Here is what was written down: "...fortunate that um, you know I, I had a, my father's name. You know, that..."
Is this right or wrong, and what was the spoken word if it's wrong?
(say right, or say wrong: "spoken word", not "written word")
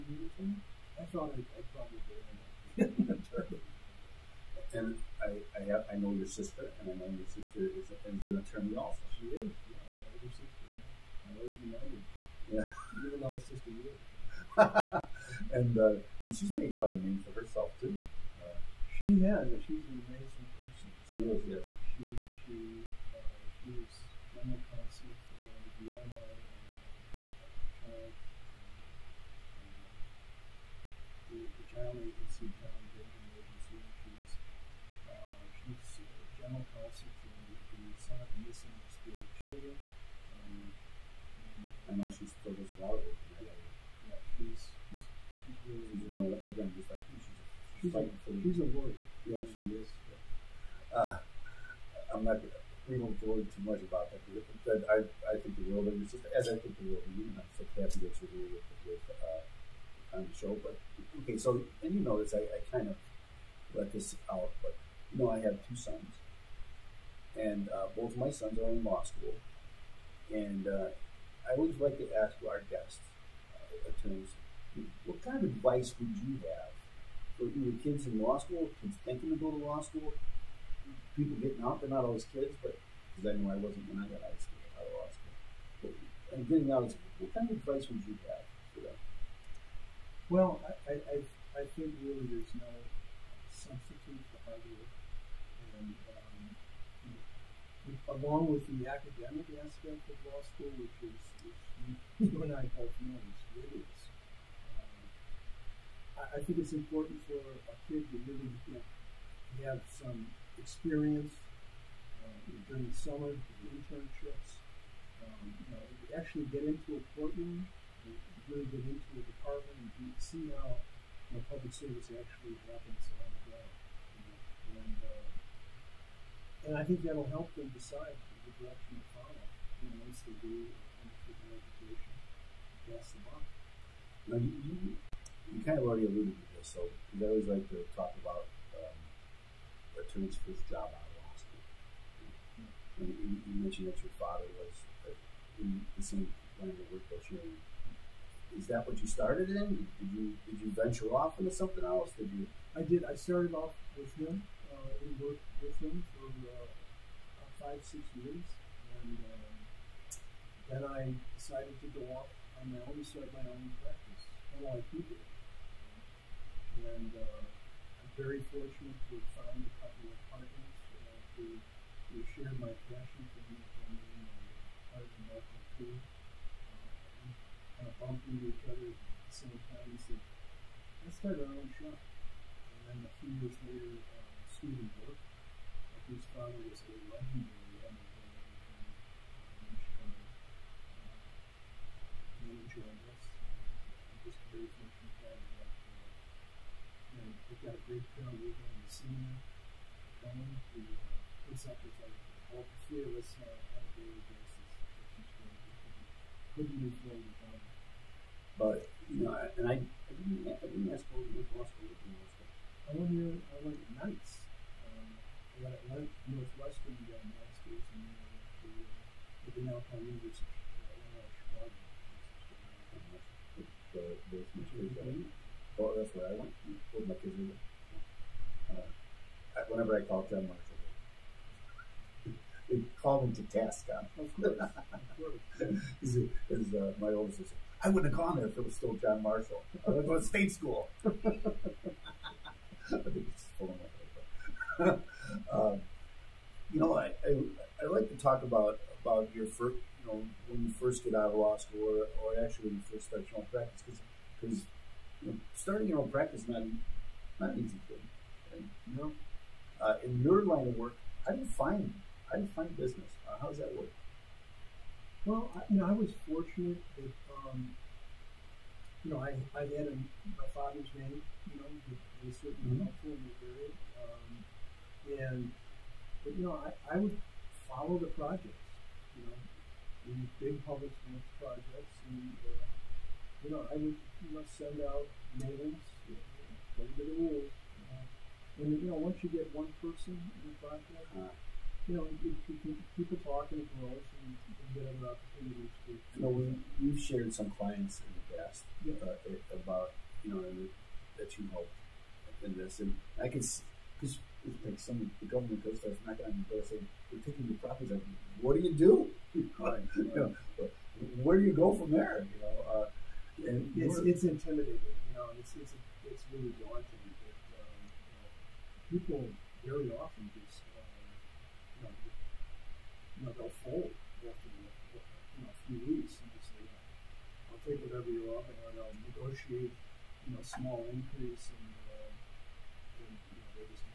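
right.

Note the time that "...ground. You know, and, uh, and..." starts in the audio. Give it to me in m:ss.
2:03.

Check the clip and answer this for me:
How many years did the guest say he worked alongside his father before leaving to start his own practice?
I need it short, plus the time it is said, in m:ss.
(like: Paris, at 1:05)
5-6 years, at 2:37.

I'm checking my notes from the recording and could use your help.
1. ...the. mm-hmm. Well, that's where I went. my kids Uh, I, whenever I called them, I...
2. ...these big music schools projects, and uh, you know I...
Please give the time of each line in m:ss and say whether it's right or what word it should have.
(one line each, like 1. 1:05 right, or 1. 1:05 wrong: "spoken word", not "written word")
1. 3:44 right
2. 4:40 wrong: "public", not "music".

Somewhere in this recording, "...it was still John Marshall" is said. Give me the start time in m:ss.
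3:58.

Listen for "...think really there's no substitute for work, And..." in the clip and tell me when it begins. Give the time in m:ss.
1:31.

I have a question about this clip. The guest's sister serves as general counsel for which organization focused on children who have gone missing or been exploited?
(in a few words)
Center for Missing and Exploited Children.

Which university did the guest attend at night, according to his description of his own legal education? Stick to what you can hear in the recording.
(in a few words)
Northwestern.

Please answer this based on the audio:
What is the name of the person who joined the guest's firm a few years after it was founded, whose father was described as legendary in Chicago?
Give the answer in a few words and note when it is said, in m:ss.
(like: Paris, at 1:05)
Stephen Burke, at 3:04.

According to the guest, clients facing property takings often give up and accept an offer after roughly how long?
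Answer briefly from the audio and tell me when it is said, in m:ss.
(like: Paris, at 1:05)
a few weeks, at 5:25.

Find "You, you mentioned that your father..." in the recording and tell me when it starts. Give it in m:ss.
2:23.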